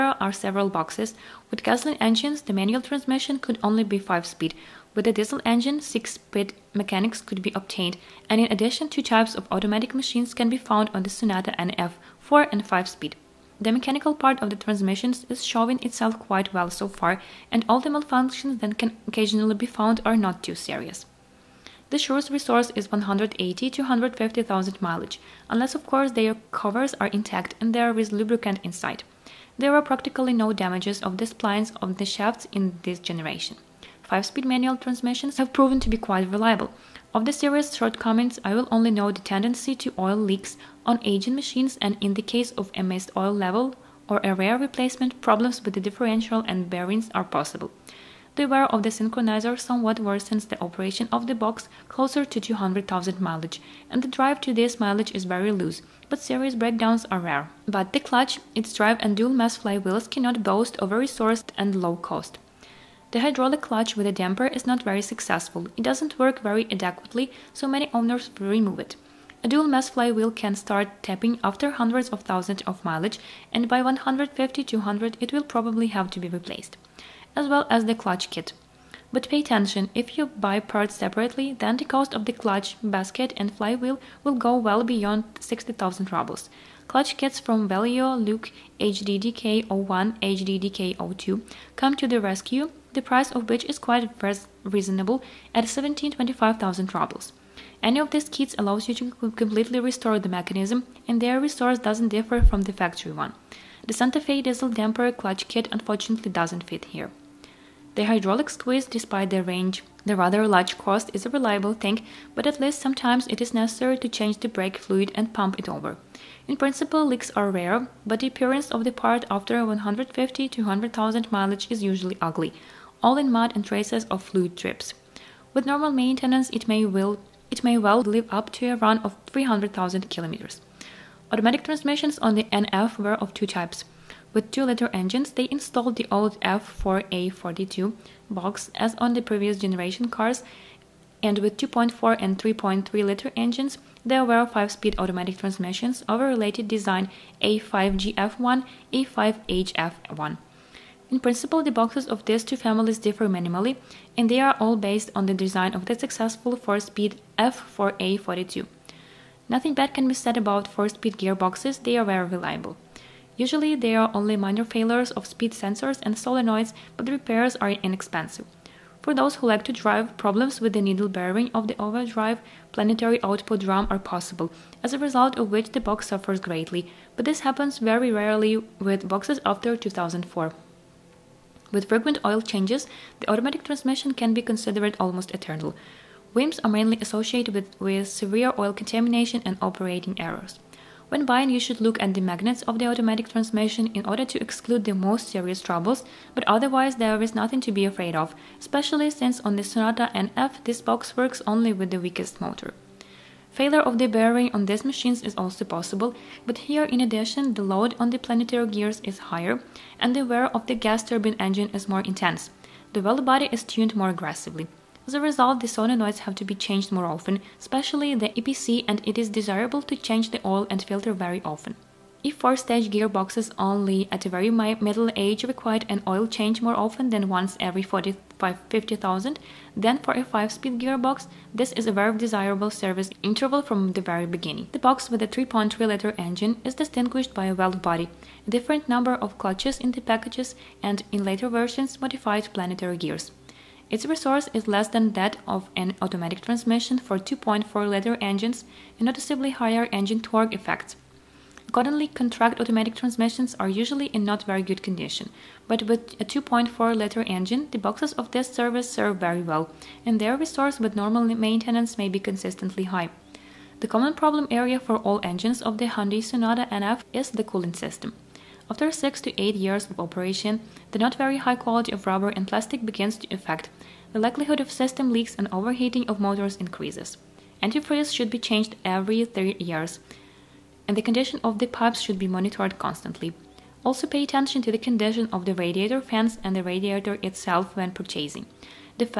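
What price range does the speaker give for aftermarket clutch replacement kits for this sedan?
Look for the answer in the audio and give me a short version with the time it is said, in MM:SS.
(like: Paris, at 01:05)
17-25,000 rubles, at 01:35.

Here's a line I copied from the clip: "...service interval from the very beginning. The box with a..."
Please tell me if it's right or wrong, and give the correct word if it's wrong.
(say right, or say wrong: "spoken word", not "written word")
right.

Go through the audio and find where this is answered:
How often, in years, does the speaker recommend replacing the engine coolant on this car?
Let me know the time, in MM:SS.
04:38.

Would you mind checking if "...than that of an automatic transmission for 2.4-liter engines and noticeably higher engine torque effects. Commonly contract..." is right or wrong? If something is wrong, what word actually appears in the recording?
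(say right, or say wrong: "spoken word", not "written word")
right.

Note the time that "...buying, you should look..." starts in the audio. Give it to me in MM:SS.
03:11.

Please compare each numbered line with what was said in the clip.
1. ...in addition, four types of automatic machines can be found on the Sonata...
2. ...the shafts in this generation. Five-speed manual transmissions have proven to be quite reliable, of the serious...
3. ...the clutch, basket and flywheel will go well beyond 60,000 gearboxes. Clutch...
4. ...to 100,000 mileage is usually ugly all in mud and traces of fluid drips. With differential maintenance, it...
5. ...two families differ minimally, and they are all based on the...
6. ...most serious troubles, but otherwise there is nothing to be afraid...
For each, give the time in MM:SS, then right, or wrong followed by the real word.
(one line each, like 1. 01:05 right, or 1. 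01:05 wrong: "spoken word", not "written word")
1. 00:08 wrong: "two", not "four"
2. 00:31 right
3. 01:22 wrong: "rubles", not "gearboxes"
4. 02:00 wrong: "normal", not "differential"
5. 02:32 right
6. 03:14 right.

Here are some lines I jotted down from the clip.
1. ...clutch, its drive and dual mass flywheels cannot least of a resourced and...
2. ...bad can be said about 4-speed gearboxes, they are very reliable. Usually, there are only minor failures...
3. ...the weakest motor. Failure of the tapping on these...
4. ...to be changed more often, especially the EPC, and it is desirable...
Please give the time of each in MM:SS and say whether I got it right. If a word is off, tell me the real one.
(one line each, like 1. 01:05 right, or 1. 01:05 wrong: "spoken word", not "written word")
1. 00:58 wrong: "boast", not "least"
2. 02:39 right
3. 03:21 wrong: "bearing", not "tapping"
4. 03:36 right.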